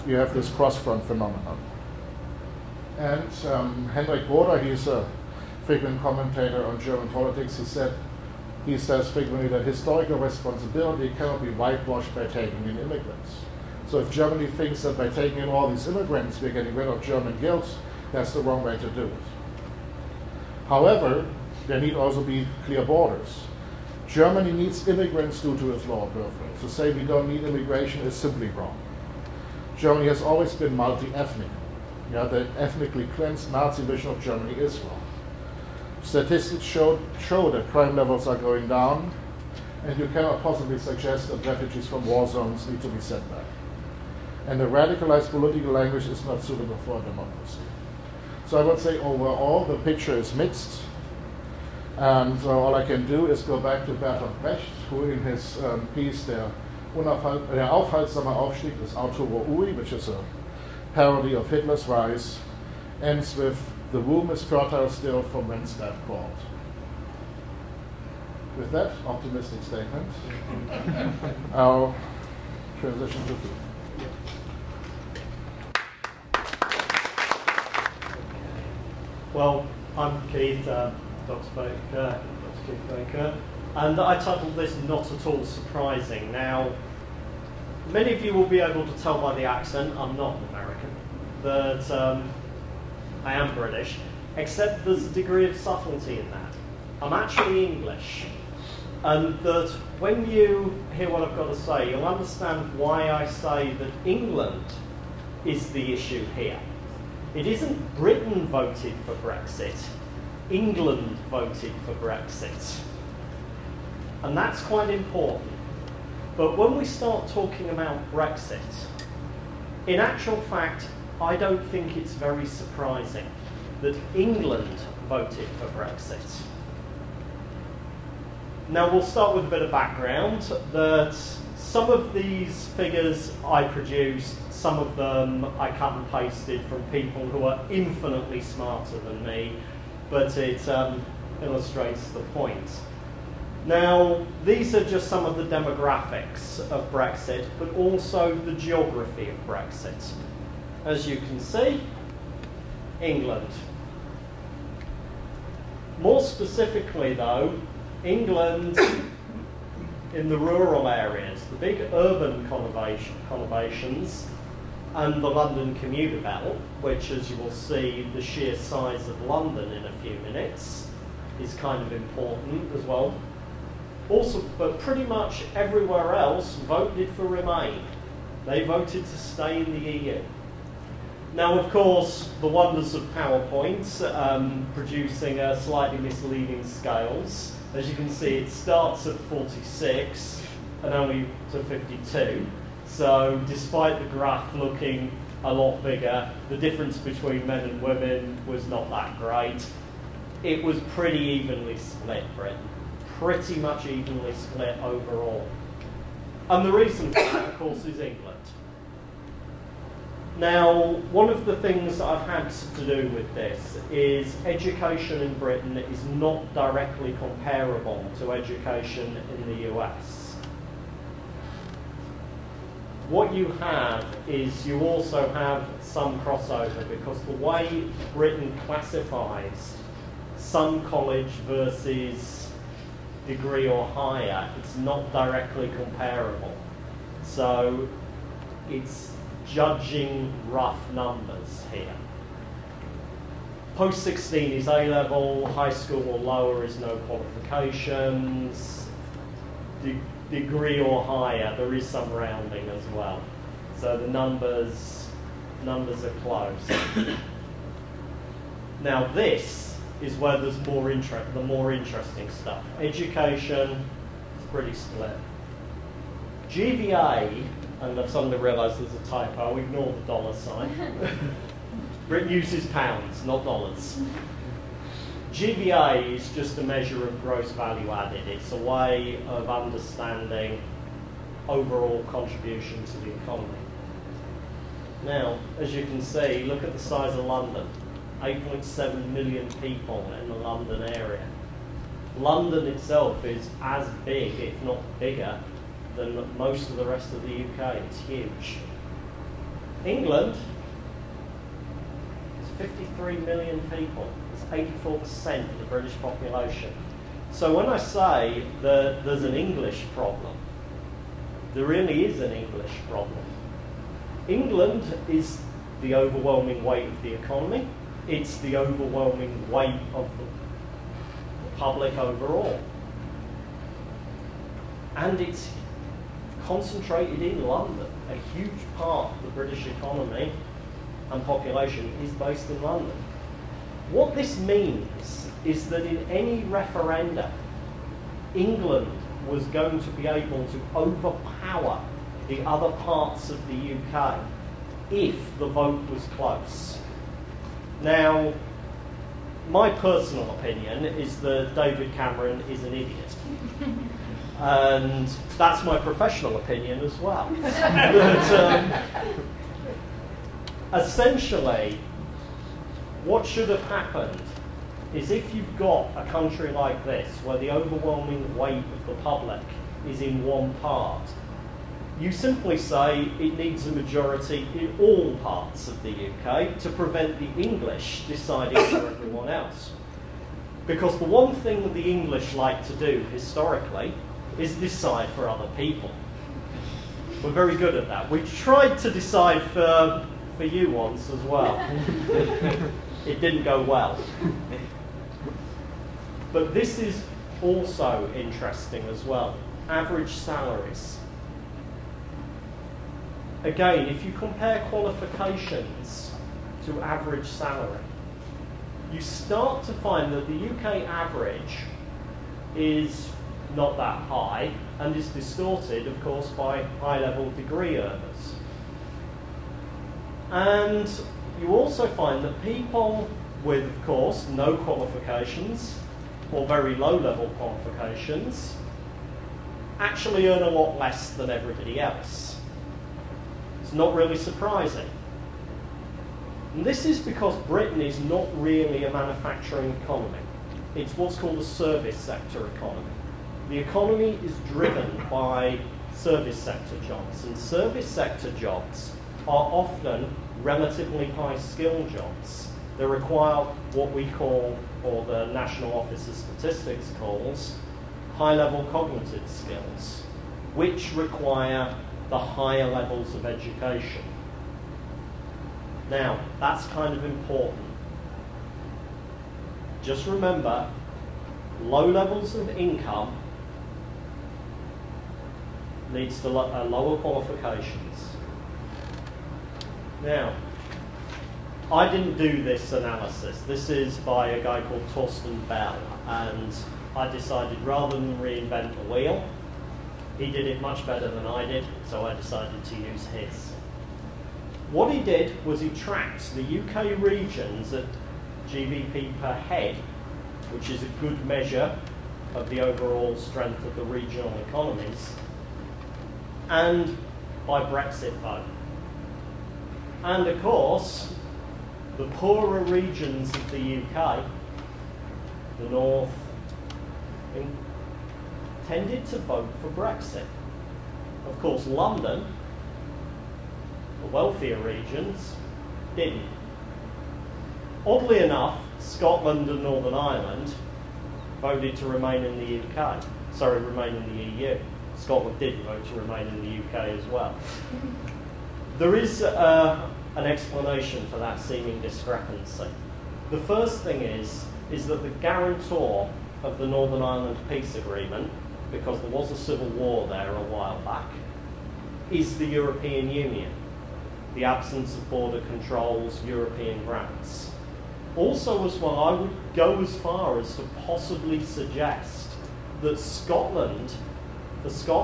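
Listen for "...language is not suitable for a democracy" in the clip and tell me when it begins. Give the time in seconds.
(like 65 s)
45 s.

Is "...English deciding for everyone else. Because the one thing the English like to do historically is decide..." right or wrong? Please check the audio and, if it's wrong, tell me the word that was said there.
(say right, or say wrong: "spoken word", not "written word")
right.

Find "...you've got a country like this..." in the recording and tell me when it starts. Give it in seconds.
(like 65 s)
365 s.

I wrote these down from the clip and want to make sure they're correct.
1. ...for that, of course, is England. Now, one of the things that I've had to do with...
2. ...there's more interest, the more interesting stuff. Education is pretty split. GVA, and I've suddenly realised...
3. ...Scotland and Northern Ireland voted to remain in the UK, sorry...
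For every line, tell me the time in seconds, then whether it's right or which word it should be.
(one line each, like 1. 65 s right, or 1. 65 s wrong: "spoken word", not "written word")
1. 207 s right
2. 260 s right
3. 528 s right.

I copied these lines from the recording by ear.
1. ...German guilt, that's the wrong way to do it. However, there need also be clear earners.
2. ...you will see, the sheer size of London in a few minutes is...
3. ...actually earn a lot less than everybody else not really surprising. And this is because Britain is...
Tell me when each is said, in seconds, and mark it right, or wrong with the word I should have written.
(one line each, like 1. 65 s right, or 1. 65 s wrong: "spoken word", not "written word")
1. 17 s wrong: "borders", not "earners"
2. 167 s right
3. 429 s right.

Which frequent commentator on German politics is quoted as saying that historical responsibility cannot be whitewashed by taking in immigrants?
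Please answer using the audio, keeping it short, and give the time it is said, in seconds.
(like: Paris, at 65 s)
Henryk Broder, at 3 s.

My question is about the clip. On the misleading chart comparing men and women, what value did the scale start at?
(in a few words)
46.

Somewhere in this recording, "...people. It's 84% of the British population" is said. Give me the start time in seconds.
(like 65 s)
303 s.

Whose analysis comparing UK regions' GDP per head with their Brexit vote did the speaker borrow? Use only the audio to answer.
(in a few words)
Torsten Bell.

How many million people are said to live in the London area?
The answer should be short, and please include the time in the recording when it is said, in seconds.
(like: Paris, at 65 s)
8.7 million, at 288 s.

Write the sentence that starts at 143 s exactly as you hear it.
Now, these are just some of the demographics of Brexit, but also the geography of Brexit.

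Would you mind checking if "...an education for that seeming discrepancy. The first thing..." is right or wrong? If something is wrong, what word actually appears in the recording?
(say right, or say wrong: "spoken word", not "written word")
wrong: "explanation", not "education".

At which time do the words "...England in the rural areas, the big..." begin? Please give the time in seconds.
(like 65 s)
158 s.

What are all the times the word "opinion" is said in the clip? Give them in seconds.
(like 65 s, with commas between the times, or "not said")
350 s, 356 s.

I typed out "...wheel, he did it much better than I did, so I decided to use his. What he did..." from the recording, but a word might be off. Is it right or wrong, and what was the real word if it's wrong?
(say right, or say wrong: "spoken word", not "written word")
right.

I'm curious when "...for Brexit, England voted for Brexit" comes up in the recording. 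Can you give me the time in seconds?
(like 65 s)
109 s.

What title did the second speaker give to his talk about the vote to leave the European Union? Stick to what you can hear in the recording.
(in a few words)
Not At All Surprising.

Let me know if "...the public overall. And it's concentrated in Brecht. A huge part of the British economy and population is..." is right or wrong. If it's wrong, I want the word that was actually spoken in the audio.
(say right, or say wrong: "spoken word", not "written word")
wrong: "London", not "Brecht".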